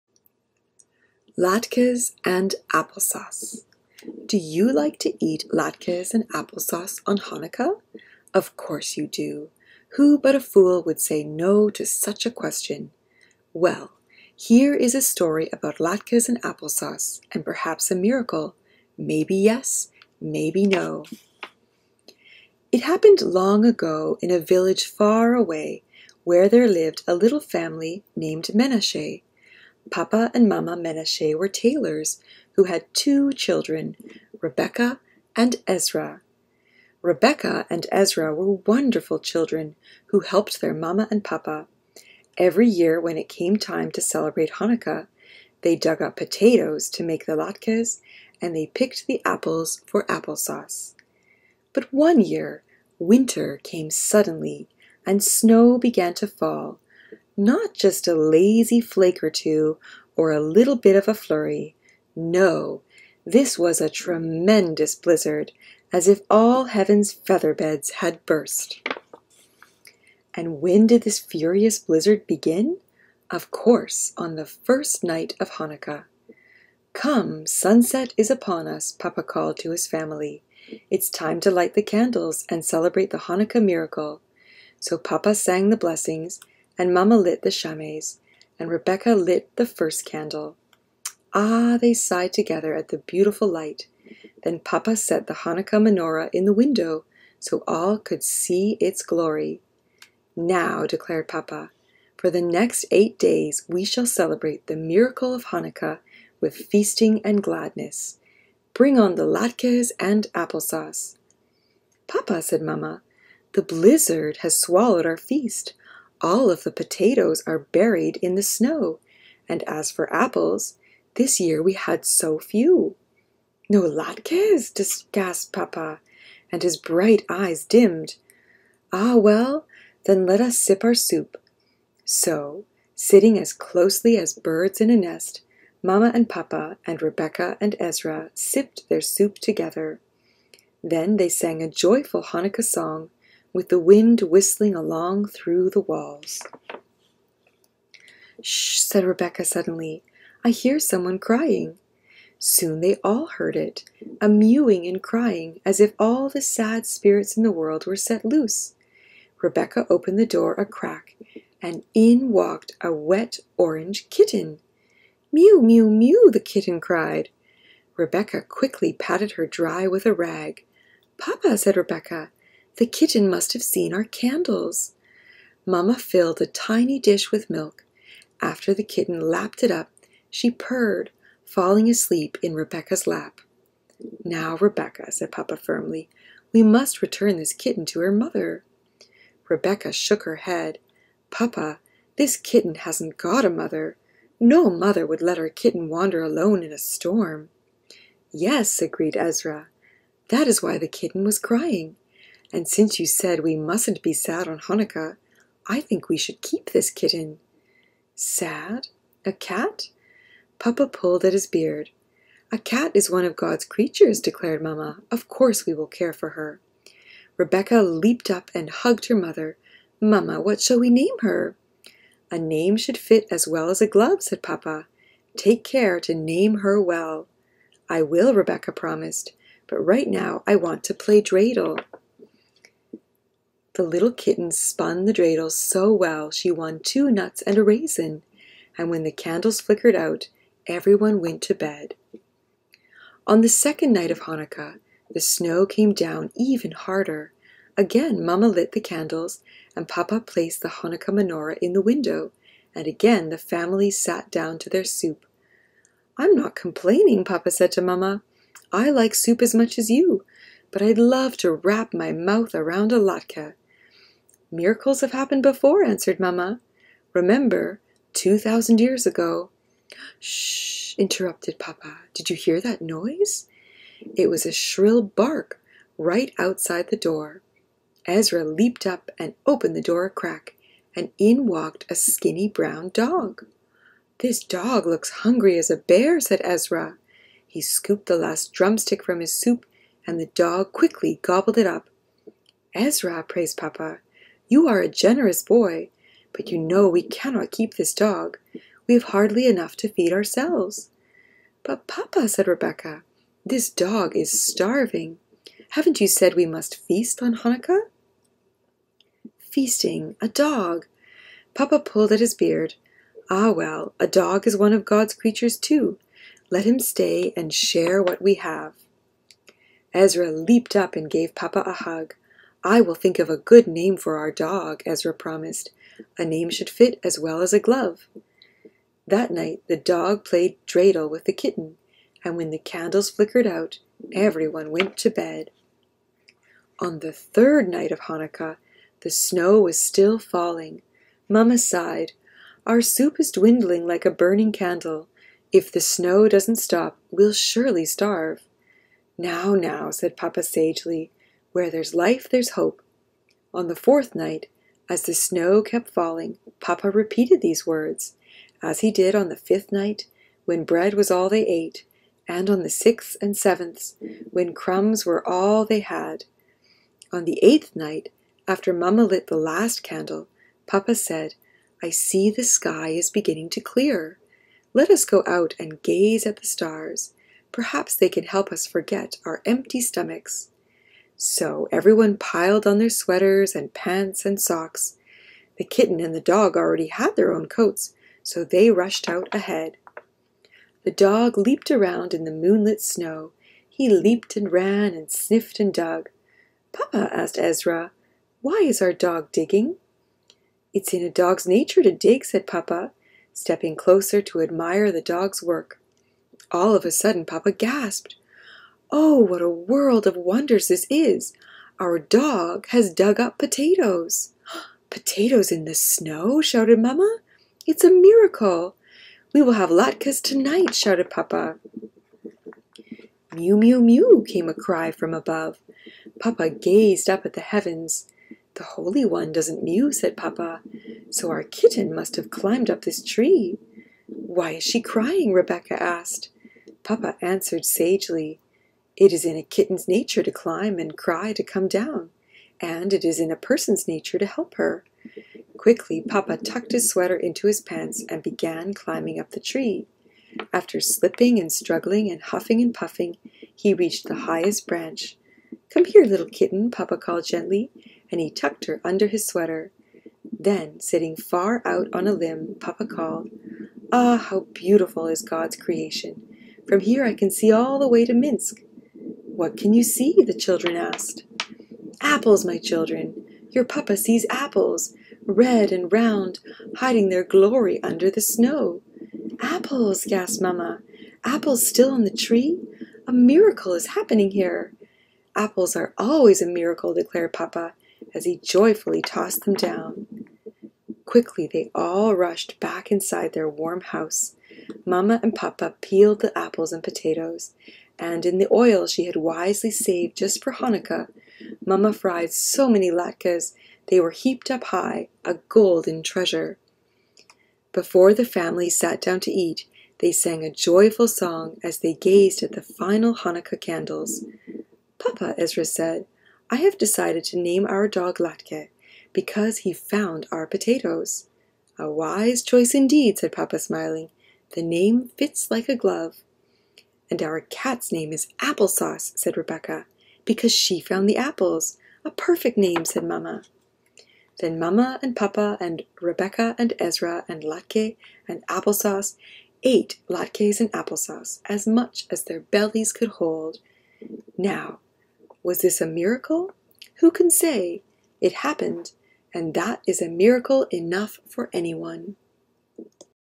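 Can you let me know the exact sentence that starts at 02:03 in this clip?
No latkes, gasped Papa, and his bright eyes dimmed.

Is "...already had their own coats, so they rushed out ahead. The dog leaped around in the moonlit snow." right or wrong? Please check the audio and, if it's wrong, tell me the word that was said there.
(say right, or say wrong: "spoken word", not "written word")
right.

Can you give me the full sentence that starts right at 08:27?
Before the family sat down to eat, they sang a joyful song as they gazed at the final Hanukkah candles.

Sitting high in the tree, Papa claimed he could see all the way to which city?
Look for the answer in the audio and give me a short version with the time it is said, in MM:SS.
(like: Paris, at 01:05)
Minsk, at 07:48.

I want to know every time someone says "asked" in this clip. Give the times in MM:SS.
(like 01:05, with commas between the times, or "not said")
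06:37, 07:15, 07:50.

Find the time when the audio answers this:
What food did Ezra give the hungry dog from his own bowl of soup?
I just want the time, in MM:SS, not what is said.
04:48.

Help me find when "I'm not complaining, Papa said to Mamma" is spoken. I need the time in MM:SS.
04:16.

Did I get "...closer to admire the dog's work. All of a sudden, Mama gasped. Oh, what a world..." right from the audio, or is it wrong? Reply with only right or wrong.
wrong.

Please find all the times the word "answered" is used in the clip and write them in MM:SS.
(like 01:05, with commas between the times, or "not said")
04:25, 07:17.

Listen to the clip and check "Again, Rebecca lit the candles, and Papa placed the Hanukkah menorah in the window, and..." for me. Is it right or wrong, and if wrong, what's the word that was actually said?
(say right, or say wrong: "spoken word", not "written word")
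wrong: "Mamma", not "Rebecca".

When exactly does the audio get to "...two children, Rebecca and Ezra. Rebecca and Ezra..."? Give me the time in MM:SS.
00:32.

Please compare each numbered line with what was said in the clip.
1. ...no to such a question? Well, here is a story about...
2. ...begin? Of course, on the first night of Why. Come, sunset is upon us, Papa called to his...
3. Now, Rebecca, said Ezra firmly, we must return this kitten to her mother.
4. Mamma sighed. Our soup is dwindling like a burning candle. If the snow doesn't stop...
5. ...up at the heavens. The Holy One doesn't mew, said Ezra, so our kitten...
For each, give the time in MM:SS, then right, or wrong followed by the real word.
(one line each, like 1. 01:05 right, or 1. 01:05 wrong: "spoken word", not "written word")
1. 00:11 right
2. 01:12 wrong: "Hanukkah", not "Why"
3. 03:04 wrong: "Papa", not "Ezra"
4. 05:41 right
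5. 07:07 wrong: "Papa", not "Ezra".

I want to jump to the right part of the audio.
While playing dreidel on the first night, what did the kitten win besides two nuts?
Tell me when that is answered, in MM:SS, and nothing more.
03:57.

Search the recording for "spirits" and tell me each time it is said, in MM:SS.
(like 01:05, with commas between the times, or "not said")
02:36.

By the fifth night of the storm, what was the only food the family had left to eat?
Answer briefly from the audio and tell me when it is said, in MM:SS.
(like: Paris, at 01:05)
Bread, at 06:00.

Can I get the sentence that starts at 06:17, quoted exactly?
Perhaps they can help us forget our empty stomachs.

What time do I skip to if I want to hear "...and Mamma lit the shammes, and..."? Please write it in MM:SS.
01:26.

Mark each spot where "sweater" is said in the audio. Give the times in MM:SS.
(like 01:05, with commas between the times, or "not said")
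06:22, 07:26, 07:39.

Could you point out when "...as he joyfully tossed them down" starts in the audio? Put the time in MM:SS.
08:08.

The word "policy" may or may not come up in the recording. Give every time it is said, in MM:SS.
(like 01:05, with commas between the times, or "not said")
not said.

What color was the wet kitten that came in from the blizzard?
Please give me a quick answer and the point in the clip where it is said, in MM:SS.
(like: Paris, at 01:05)
Orange, at 02:43.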